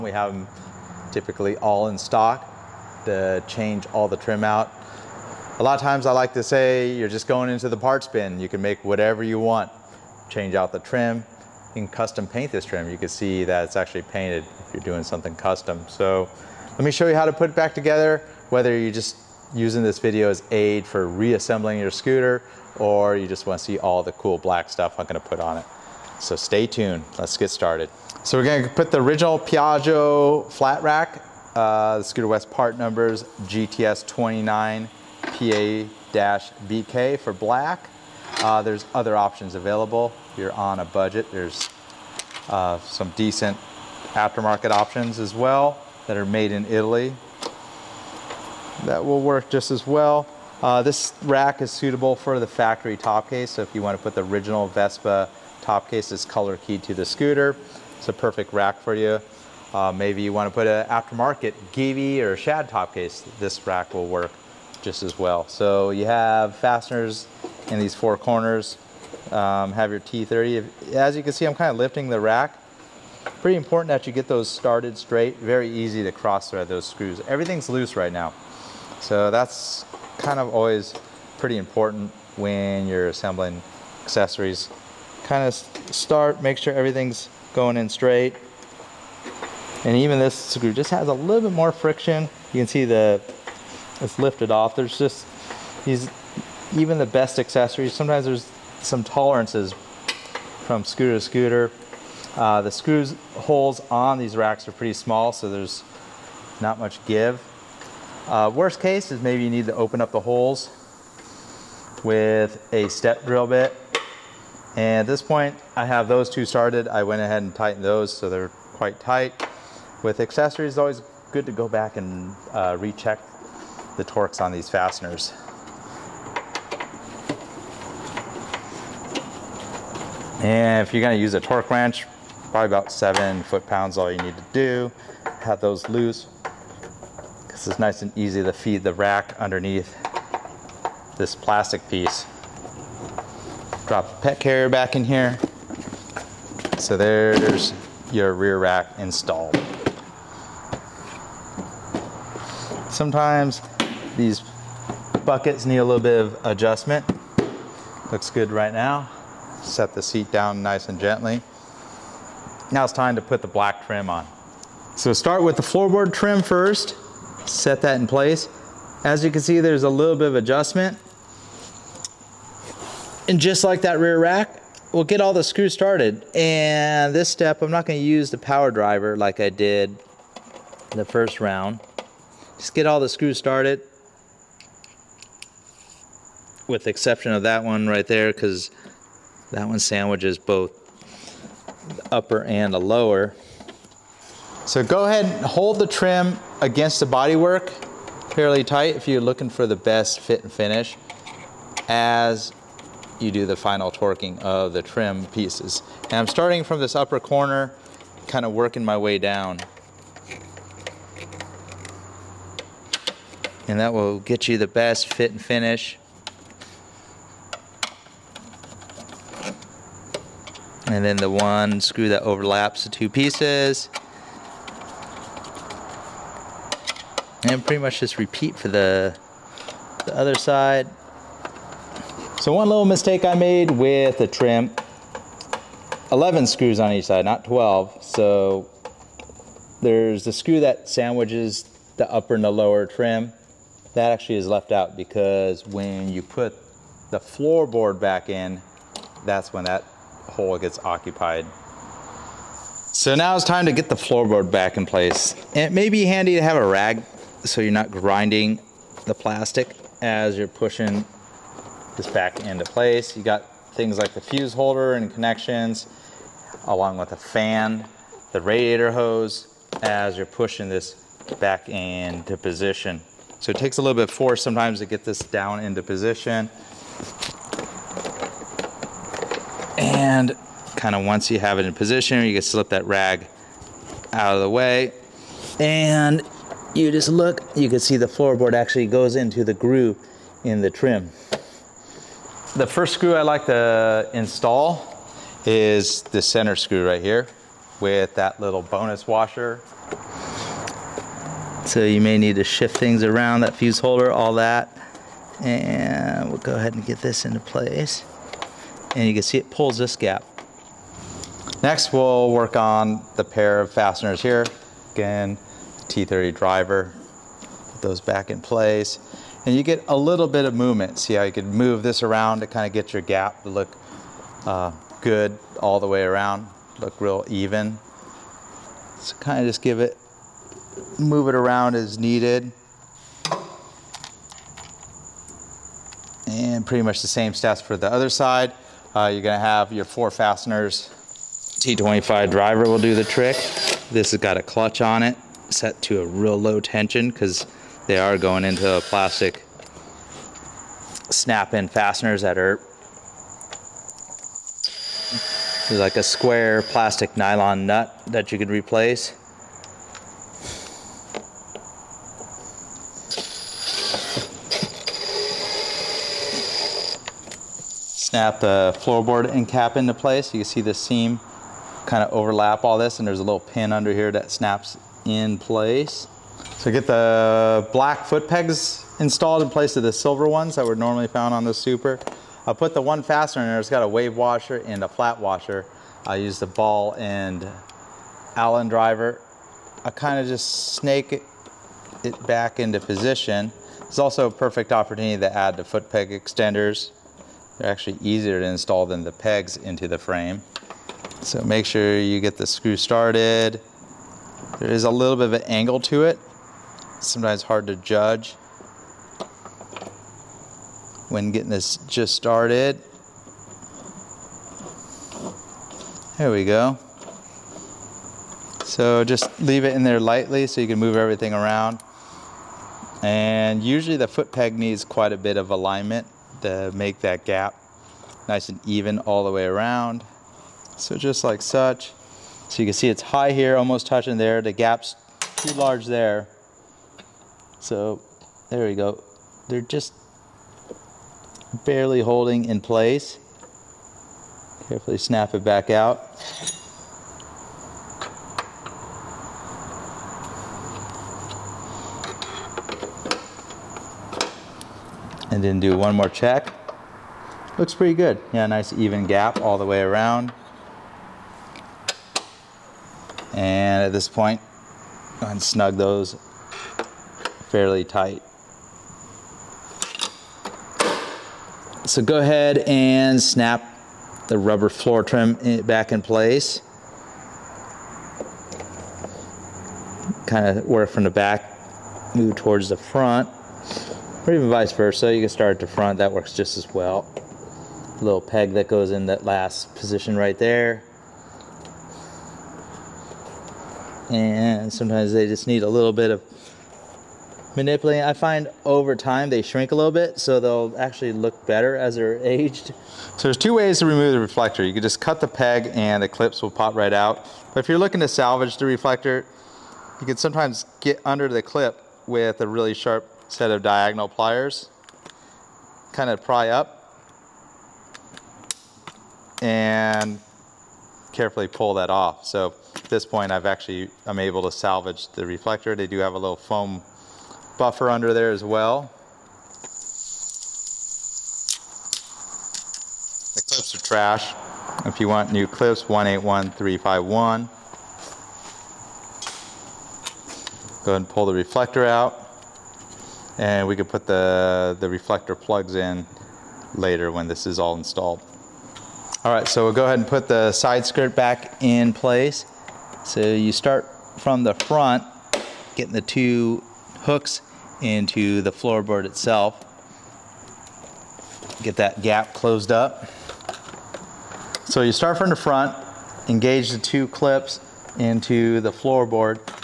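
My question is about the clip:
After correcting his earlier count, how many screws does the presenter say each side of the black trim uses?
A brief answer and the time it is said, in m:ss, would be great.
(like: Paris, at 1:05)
11, at 3:56.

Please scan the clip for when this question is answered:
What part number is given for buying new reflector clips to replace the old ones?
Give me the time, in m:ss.
8:55.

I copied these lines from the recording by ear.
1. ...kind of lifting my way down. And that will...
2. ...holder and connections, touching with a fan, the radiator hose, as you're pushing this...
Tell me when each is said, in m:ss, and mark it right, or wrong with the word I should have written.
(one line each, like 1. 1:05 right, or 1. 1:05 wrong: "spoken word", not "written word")
1. 3:28 wrong: "working", not "lifting"
2. 4:24 wrong: "along", not "touching".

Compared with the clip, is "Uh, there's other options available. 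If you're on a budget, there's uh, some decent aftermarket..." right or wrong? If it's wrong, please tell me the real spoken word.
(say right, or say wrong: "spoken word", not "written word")
right.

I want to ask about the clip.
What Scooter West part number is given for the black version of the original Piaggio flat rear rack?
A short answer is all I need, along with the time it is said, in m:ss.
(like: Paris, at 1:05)
GTS 29 PA-BK, at 0:33.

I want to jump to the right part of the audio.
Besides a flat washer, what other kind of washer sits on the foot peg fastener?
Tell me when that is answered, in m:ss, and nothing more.
6:23.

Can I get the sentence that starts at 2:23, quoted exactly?
Drop the pet carrier back in here.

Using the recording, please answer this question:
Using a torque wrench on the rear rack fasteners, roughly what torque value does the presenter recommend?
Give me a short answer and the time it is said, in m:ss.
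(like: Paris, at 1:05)
7 foot pounds, at 2:12.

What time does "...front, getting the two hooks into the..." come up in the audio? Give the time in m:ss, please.
9:14.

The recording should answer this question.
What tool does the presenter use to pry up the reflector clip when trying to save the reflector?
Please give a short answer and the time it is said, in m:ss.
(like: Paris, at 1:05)
diagonal pliers, at 8:33.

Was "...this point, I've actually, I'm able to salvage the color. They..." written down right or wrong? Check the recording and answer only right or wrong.
wrong.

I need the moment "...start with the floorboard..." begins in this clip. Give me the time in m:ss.
2:45.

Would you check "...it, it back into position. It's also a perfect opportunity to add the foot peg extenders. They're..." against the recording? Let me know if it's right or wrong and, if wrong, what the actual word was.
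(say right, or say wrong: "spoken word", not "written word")
right.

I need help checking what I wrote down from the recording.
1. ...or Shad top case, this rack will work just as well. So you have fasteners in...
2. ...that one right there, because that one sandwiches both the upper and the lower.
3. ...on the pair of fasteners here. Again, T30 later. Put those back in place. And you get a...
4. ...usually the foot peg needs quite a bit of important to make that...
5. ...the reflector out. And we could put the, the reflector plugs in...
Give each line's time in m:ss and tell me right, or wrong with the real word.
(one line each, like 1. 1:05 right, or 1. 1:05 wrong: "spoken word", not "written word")
1. 1:02 right
2. 3:07 right
3. 5:12 wrong: "driver", not "later"
4. 7:03 wrong: "alignment", not "important"
5. 9:01 right.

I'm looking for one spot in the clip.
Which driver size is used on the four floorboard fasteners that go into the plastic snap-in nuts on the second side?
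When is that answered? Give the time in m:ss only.
5:41.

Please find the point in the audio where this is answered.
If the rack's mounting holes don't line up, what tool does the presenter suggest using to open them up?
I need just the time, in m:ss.
1:52.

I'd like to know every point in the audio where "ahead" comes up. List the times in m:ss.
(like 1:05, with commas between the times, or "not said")
1:57, 3:15, 5:06, 7:45, 7:52, 9:00, 9:09.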